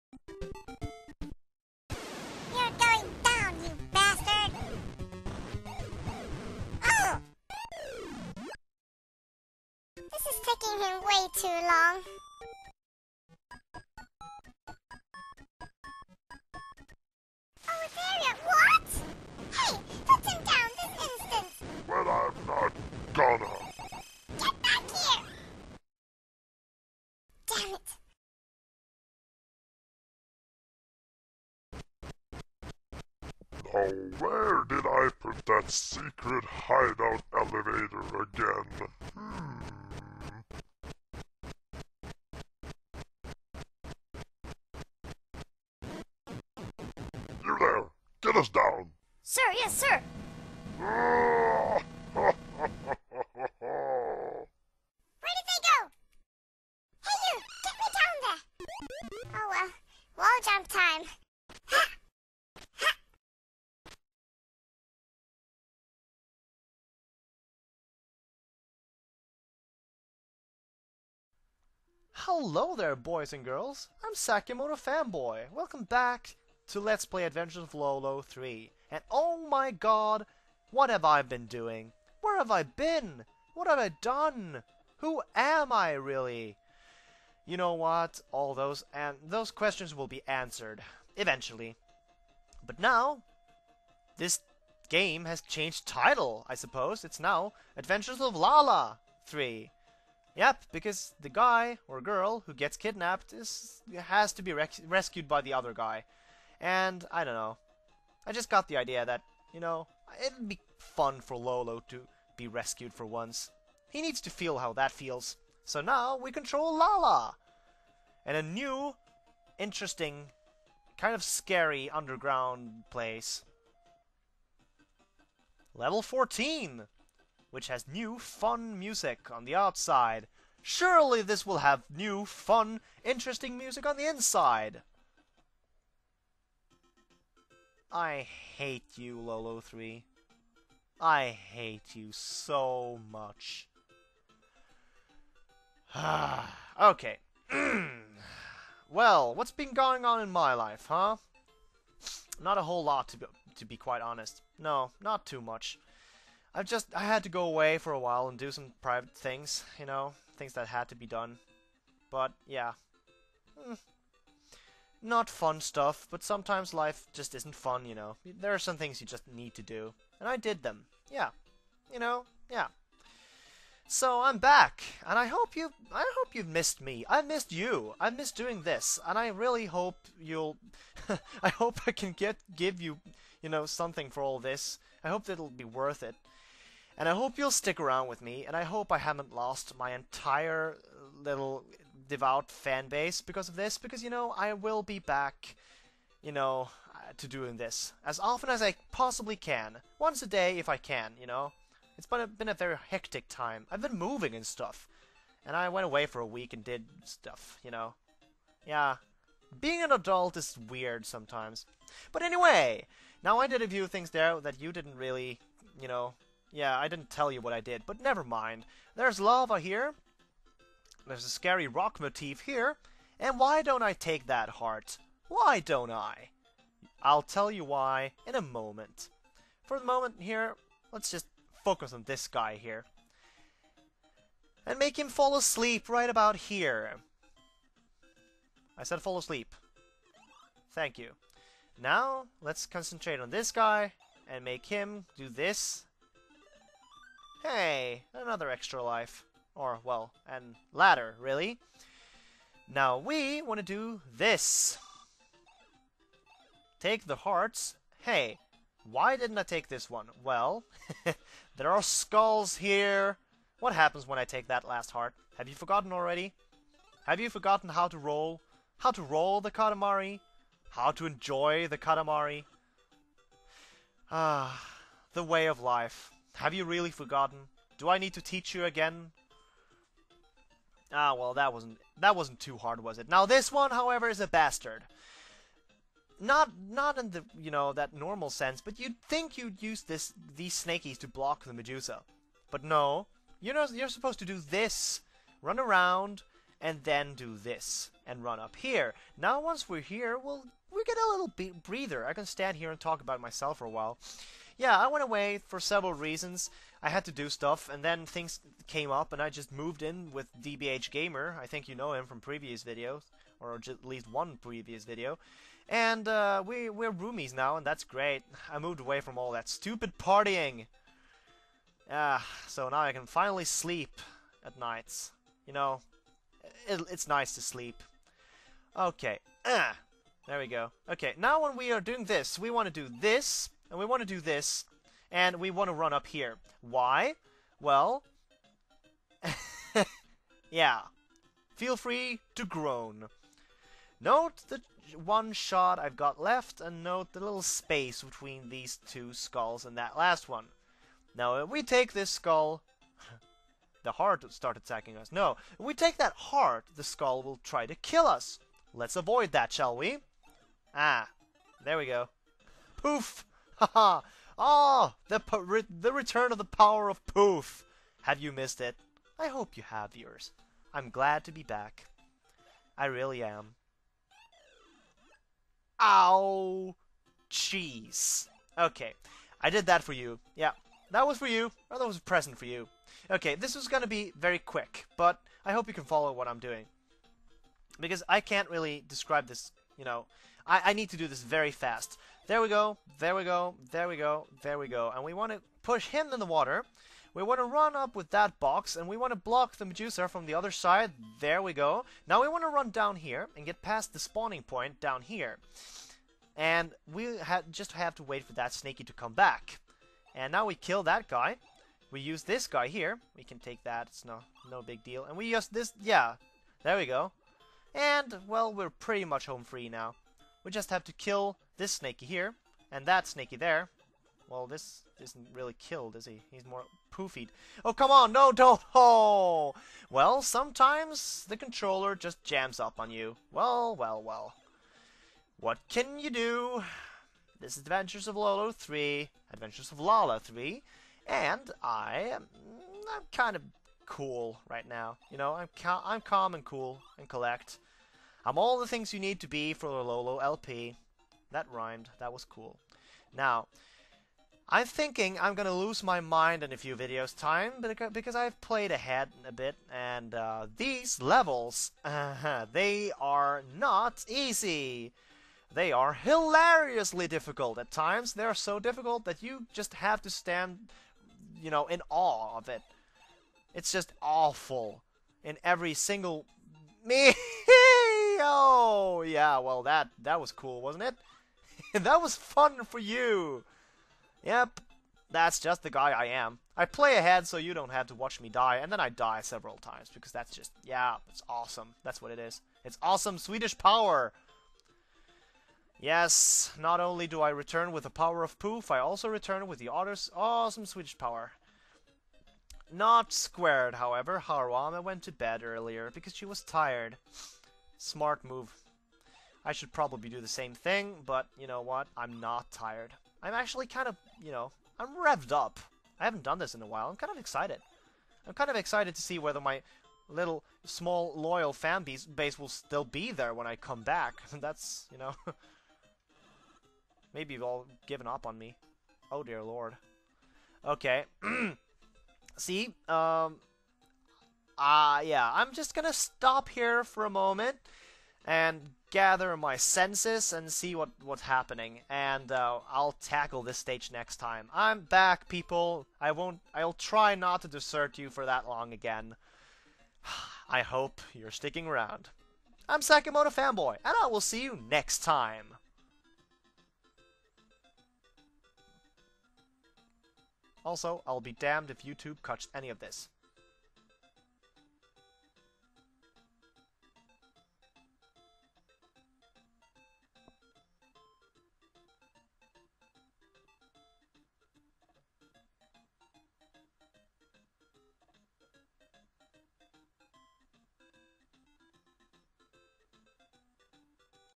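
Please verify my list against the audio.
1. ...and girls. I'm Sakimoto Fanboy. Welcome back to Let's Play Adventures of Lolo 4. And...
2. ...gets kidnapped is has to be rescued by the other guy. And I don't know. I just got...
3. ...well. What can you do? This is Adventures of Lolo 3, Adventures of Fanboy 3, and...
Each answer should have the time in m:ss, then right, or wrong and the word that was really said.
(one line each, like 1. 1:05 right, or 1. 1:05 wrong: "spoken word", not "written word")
1. 1:13 wrong: "3", not "4"
2. 1:42 right
3. 7:14 wrong: "Lala", not "Fanboy".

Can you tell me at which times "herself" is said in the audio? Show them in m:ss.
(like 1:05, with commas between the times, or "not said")
not said.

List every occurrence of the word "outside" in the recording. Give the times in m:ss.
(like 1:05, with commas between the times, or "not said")
2:09.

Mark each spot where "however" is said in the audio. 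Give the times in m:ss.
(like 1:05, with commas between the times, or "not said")
4:43, 8:23.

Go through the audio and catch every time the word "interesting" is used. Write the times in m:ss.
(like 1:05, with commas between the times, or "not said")
1:59, 2:13.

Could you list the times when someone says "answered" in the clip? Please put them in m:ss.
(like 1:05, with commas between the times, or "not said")
1:30.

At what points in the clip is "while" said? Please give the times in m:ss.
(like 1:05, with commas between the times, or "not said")
2:37, 5:03, 8:36.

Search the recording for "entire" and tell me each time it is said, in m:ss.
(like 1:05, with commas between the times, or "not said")
3:09.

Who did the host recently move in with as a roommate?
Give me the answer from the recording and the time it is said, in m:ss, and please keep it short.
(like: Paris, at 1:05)
DBH Gamer, at 5:10.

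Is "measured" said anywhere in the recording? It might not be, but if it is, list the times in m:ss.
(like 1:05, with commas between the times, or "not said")
not said.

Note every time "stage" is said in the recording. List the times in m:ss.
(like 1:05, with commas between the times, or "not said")
9:03.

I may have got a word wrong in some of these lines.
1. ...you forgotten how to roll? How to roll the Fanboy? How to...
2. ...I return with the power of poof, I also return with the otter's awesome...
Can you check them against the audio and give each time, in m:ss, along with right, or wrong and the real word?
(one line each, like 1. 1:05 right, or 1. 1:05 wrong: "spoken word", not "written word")
1. 4:27 wrong: "Katamari", not "Fanboy"
2. 8:17 right.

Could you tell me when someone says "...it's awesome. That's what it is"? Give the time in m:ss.
8:11.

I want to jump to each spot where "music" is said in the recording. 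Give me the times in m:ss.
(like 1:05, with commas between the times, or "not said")
2:08, 2:13.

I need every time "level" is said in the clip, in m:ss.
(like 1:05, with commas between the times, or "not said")
2:05, 7:41.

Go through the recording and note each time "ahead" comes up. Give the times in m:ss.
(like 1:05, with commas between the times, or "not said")
7:38, 8:06.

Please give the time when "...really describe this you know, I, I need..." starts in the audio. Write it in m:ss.
6:28.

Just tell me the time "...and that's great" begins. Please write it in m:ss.
5:17.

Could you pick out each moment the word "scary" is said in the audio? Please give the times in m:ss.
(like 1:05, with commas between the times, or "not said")
2:01, 3:41.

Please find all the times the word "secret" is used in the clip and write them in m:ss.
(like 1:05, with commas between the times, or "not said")
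0:35.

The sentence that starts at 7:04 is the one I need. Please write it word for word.
Well, this isn't really killed, is he?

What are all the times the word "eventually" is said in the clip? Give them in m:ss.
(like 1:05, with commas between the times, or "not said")
1:31.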